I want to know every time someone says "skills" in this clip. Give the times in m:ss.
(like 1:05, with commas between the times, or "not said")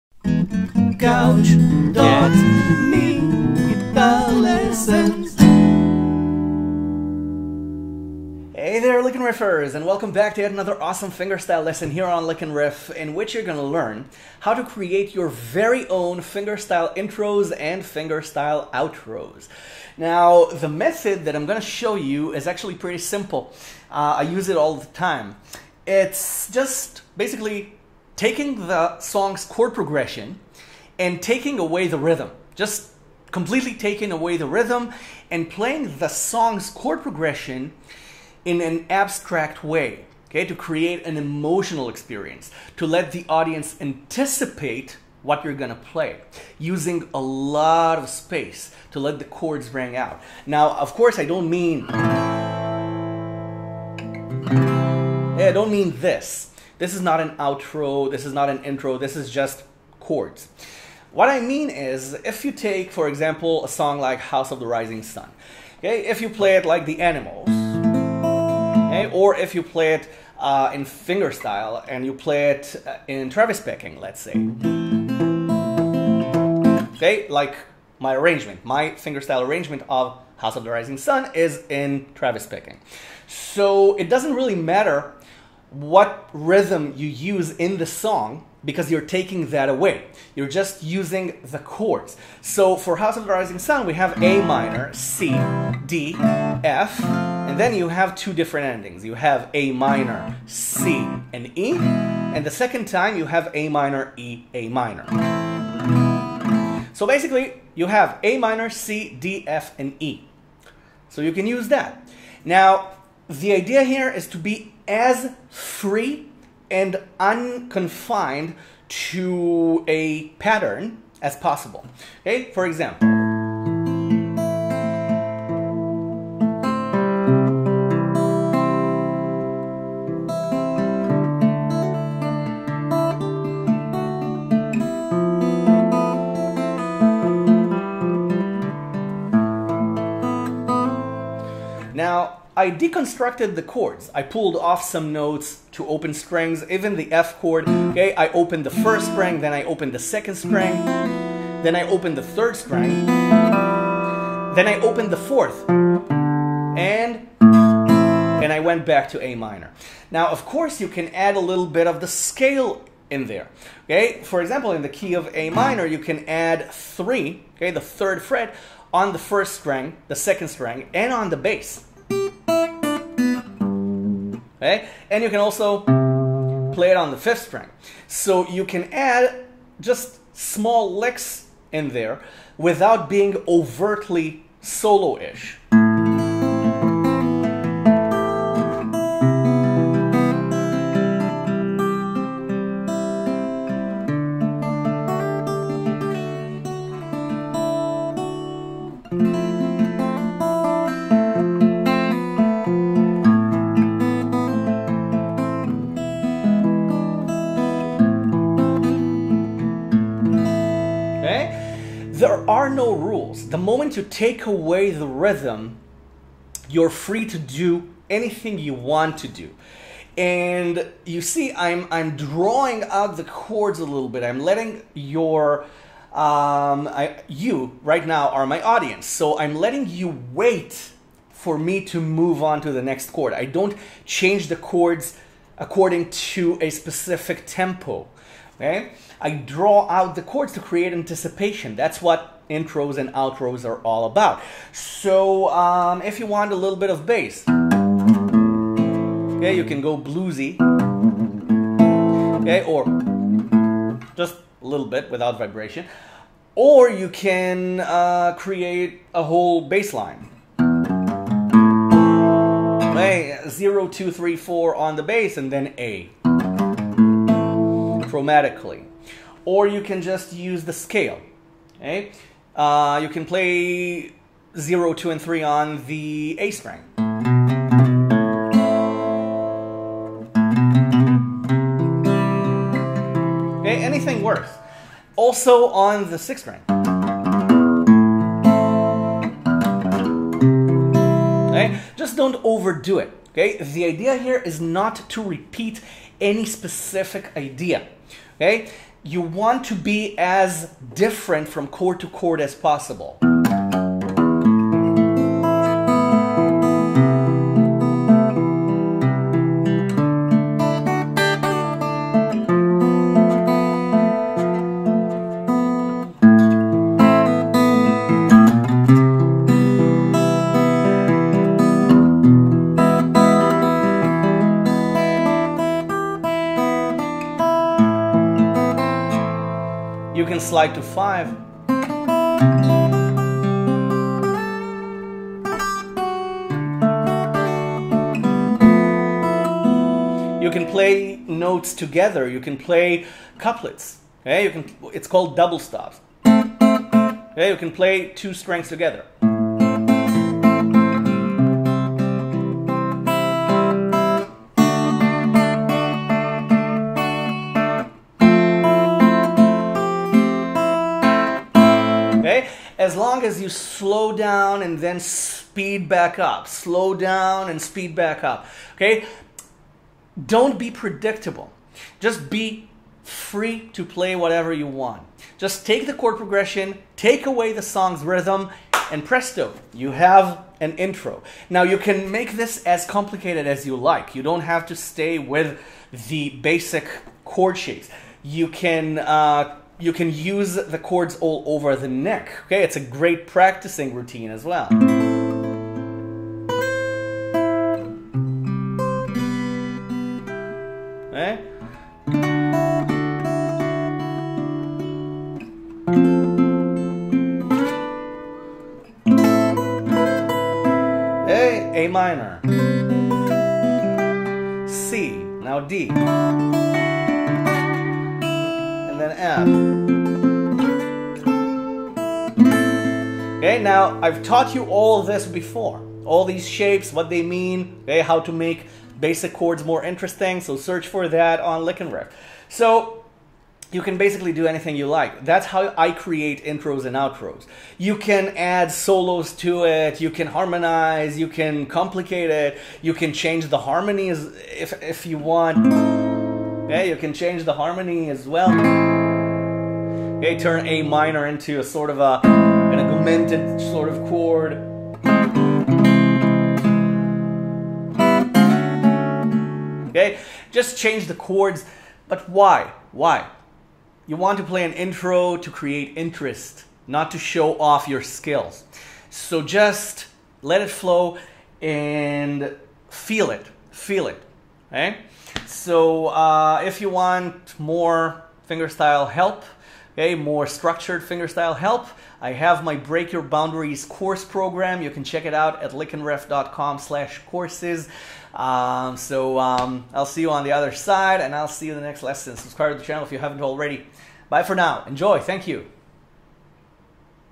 7:48.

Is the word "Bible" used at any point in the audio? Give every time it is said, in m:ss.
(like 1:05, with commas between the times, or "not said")
not said.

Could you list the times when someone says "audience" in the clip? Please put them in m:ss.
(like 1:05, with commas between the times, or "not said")
0:43, 3:48.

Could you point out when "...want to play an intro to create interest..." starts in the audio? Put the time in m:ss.
7:44.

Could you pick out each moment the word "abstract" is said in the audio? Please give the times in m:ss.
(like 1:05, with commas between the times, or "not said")
0:38.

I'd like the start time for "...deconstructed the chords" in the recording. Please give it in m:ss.
2:22.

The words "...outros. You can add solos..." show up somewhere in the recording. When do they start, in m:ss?
7:16.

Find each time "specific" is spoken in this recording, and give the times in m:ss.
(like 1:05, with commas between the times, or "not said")
3:56, 4:56.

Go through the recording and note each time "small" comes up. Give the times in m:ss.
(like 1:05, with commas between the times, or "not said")
3:00.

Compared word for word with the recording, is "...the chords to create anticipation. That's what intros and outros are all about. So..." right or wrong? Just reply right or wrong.
right.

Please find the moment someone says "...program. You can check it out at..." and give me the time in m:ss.
8:04.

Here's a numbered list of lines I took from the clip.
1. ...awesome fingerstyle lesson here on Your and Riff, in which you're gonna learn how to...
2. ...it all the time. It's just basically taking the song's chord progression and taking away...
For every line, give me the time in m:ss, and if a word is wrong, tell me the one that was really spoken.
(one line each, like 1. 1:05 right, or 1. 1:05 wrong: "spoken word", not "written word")
1. 0:10 wrong: "Lick", not "Your"
2. 0:24 right.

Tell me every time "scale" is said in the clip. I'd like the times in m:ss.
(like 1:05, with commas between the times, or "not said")
2:42, 4:30.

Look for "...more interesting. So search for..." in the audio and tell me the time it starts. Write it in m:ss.
7:09.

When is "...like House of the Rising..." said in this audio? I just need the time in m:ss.
1:03.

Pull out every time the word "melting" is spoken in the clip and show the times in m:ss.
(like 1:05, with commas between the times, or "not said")
not said.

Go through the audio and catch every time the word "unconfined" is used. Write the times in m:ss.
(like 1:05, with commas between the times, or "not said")
1:57.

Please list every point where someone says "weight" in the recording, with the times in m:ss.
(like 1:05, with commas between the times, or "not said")
not said.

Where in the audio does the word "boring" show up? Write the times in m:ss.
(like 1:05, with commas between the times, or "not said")
not said.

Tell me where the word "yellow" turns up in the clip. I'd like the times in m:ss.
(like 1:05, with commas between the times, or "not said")
not said.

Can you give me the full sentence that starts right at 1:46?
So basically, you have A minor, C, D, F, and E.